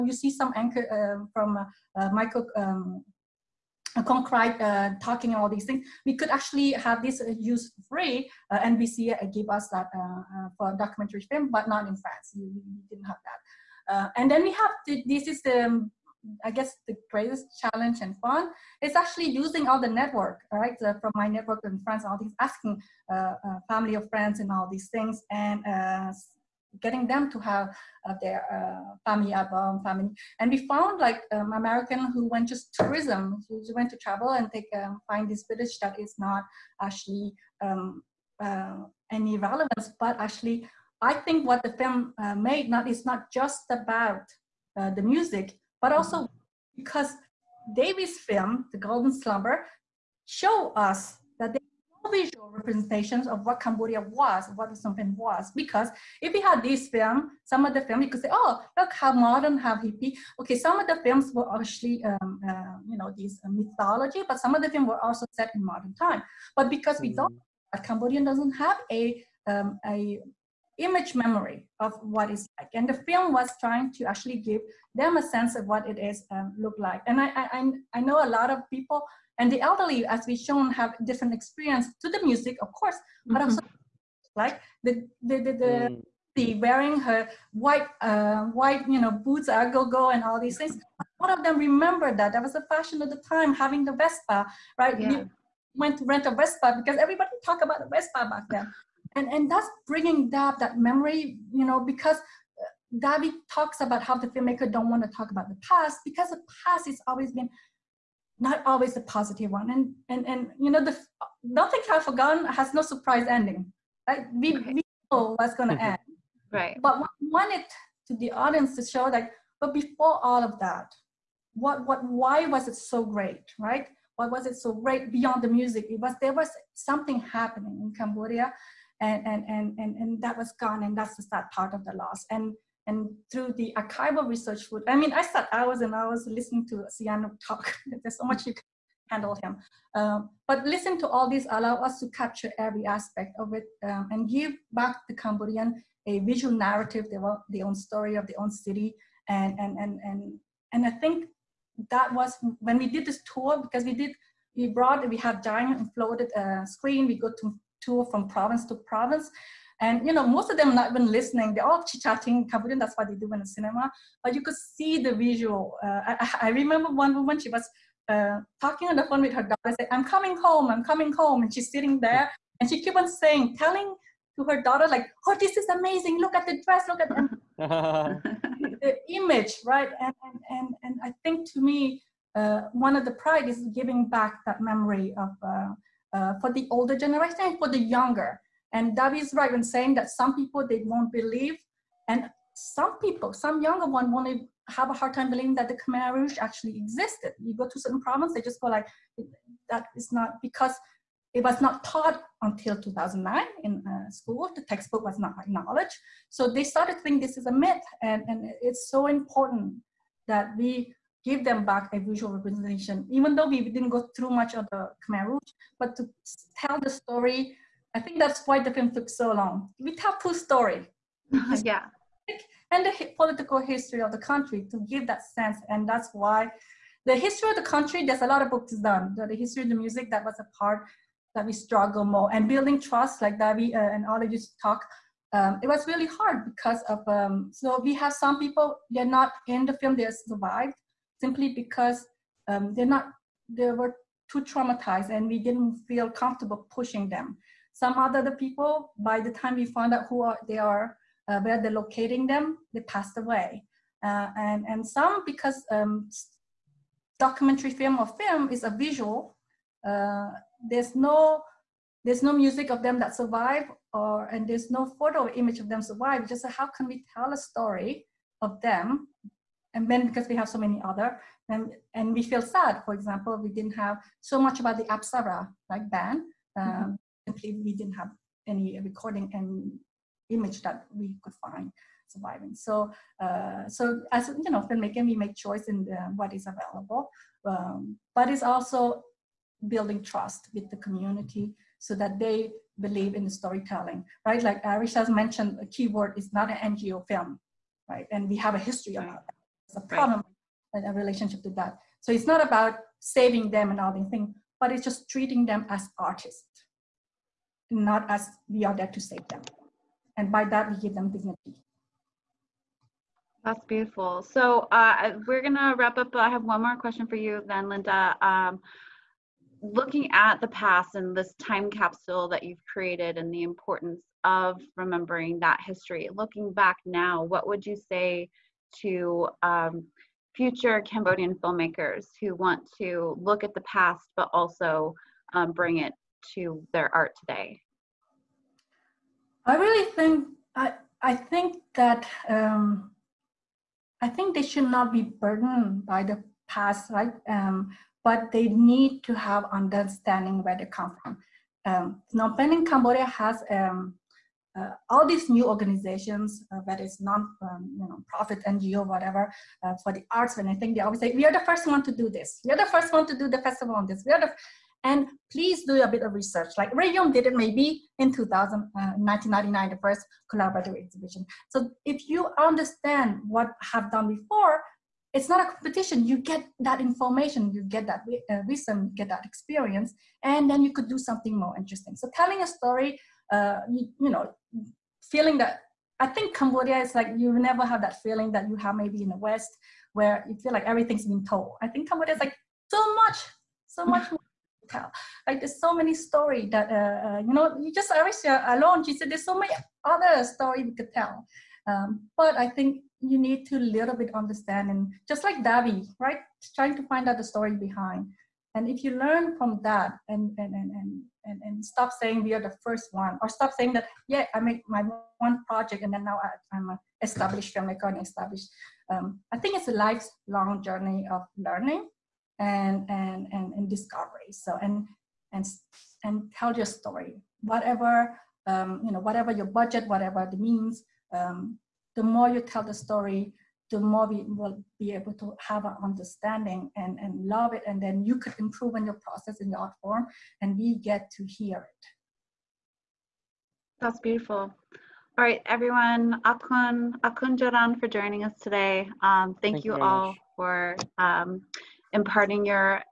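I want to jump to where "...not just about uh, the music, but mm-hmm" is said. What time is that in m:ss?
0:43.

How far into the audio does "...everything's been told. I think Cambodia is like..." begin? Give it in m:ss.
6:30.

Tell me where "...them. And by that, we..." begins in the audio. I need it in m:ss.
5:09.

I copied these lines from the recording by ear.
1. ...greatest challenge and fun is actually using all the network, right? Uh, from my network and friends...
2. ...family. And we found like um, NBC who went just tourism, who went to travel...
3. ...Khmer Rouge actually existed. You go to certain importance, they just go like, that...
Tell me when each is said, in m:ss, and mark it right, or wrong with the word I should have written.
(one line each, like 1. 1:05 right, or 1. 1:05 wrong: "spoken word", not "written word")
1. 0:17 right
2. 0:29 wrong: "American", not "NBC"
3. 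3:15 wrong: "province", not "importance".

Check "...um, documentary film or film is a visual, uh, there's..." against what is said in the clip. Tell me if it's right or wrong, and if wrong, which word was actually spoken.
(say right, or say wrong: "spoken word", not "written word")
right.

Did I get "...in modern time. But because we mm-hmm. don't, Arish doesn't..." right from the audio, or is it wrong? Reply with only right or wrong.
wrong.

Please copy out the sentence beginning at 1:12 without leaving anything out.
And the film was trying to actually give them a sense of what it is um, look like.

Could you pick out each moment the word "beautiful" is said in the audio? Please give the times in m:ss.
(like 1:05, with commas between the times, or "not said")
5:13, 7:23.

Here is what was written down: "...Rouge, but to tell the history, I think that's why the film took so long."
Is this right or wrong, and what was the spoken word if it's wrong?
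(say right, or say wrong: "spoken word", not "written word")
wrong: "story", not "history".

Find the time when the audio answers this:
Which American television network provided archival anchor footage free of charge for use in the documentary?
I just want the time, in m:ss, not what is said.
0:08.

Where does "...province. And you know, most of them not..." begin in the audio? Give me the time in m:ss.
2:38.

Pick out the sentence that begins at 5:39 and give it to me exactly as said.
I really think I I think that um, I think they should not be burdened by the past, right?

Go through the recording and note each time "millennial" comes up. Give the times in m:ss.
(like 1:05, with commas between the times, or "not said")
not said.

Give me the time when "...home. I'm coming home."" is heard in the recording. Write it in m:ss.
2:50.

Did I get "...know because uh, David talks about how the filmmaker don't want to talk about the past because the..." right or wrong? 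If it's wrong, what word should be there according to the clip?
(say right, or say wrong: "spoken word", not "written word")
right.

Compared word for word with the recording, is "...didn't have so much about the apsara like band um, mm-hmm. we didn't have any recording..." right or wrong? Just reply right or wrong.
right.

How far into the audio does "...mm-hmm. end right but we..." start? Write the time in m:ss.
1:55.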